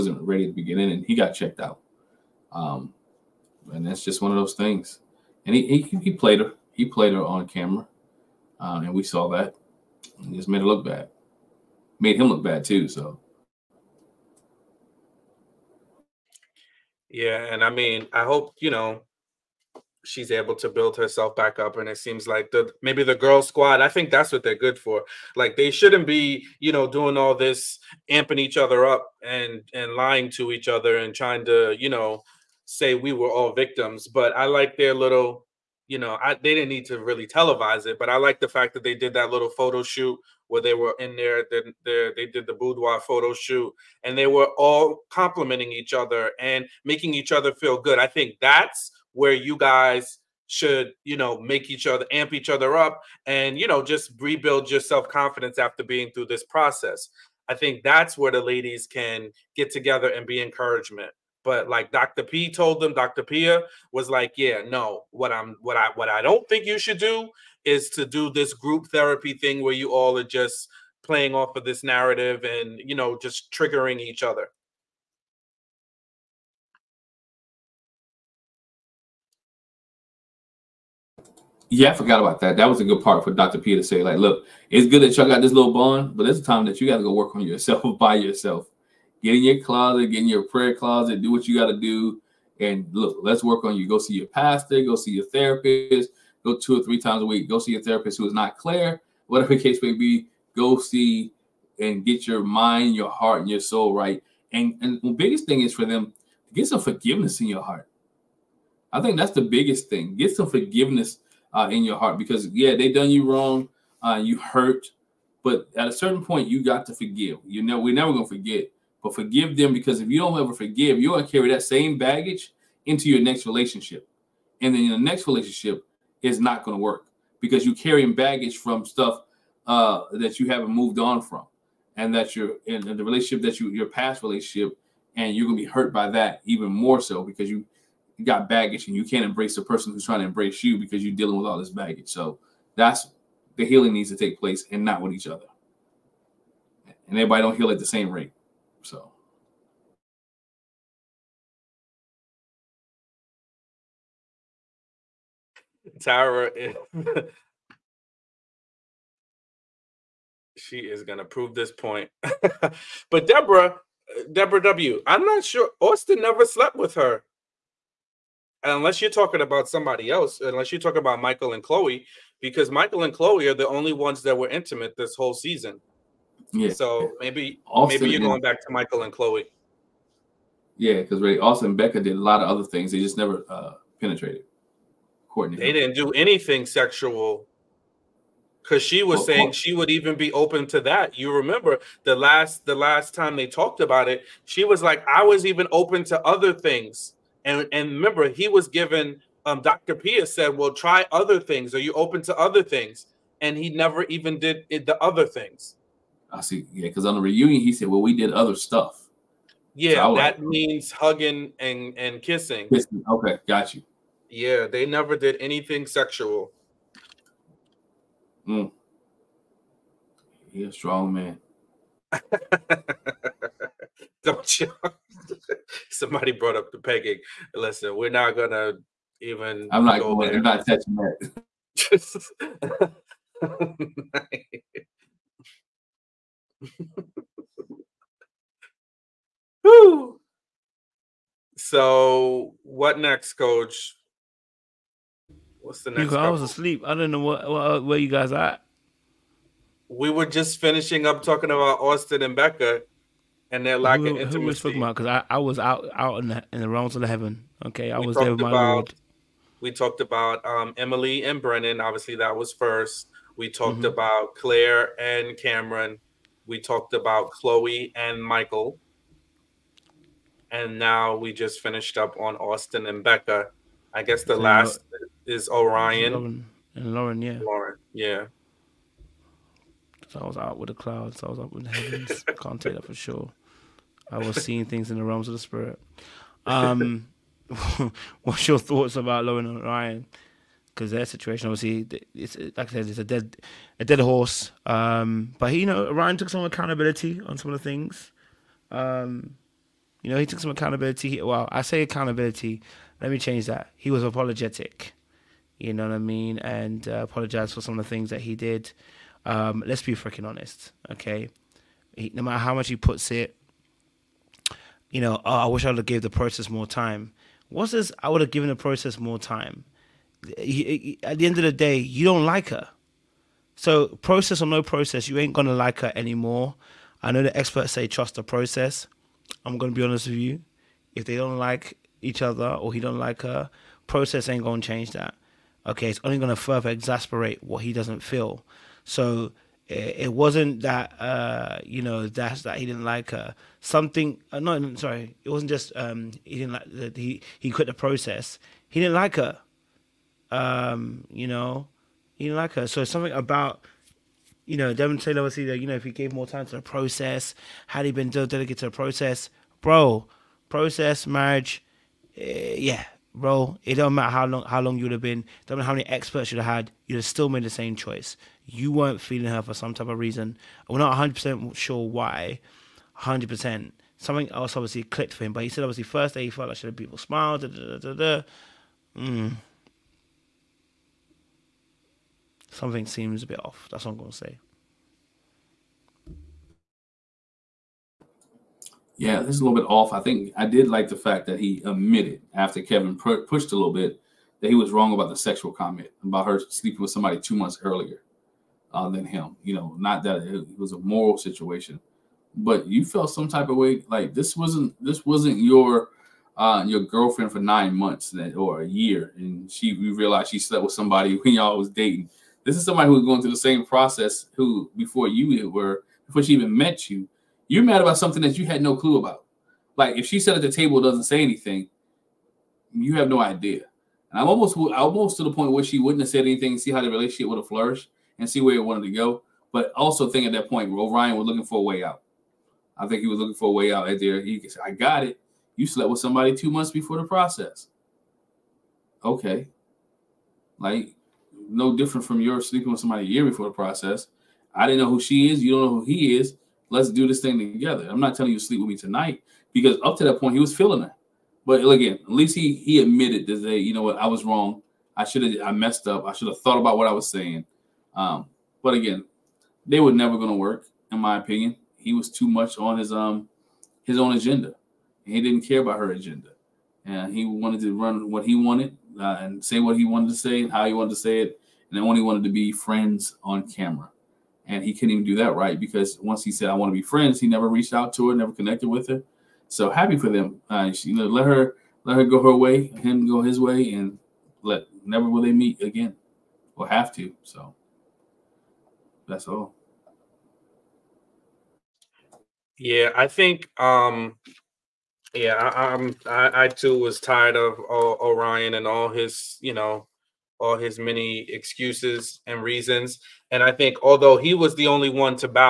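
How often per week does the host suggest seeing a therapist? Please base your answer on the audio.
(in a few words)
2 or 3 times.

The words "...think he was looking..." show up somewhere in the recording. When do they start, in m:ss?
7:12.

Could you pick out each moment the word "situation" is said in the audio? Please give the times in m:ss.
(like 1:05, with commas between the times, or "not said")
4:51, 6:41.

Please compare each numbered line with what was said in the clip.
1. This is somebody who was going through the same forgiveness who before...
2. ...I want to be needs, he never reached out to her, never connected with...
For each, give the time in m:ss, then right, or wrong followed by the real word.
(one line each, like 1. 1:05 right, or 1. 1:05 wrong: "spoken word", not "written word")
1. 6:52 wrong: "process", not "forgiveness"
2. 7:56 wrong: "friends", not "needs".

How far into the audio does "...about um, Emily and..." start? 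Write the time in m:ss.
4:19.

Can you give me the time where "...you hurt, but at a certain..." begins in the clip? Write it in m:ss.
1:54.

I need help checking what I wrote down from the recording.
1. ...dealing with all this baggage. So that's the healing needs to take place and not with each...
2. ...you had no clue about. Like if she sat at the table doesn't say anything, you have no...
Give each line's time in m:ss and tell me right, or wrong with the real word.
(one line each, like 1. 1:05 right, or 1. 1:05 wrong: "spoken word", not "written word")
1. 2:21 right
2. 6:58 right.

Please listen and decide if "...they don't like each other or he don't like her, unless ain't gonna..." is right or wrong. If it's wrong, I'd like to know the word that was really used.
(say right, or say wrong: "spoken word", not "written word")
wrong: "process", not "unless".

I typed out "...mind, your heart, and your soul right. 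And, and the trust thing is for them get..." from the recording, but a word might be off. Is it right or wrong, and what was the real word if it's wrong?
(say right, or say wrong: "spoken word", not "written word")
wrong: "biggest", not "trust".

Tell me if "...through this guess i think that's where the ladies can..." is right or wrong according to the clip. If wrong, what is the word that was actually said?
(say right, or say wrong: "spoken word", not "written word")
wrong: "process", not "guess".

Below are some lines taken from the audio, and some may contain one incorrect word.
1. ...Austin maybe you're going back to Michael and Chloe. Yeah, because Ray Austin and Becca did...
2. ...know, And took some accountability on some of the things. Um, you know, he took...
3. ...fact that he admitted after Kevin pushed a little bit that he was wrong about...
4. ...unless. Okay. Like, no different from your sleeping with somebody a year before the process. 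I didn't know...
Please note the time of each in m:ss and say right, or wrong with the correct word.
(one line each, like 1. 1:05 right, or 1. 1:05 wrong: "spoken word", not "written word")
1. 2:57 right
2. 4:55 wrong: "Ryan", not "And"
3. 6:30 right
4. 7:17 wrong: "process", not "unless".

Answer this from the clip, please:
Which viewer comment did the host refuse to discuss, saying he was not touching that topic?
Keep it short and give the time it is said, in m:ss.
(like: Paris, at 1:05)
Pegging, at 3:46.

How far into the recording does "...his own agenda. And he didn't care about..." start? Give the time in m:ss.
7:43.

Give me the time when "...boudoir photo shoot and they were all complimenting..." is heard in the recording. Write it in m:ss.
0:42.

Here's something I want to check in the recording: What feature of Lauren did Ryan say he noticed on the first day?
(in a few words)
Beautiful smile.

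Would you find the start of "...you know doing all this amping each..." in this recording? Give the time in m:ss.
0:26.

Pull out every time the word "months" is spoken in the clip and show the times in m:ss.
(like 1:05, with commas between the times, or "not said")
6:37, 6:47, 7:16.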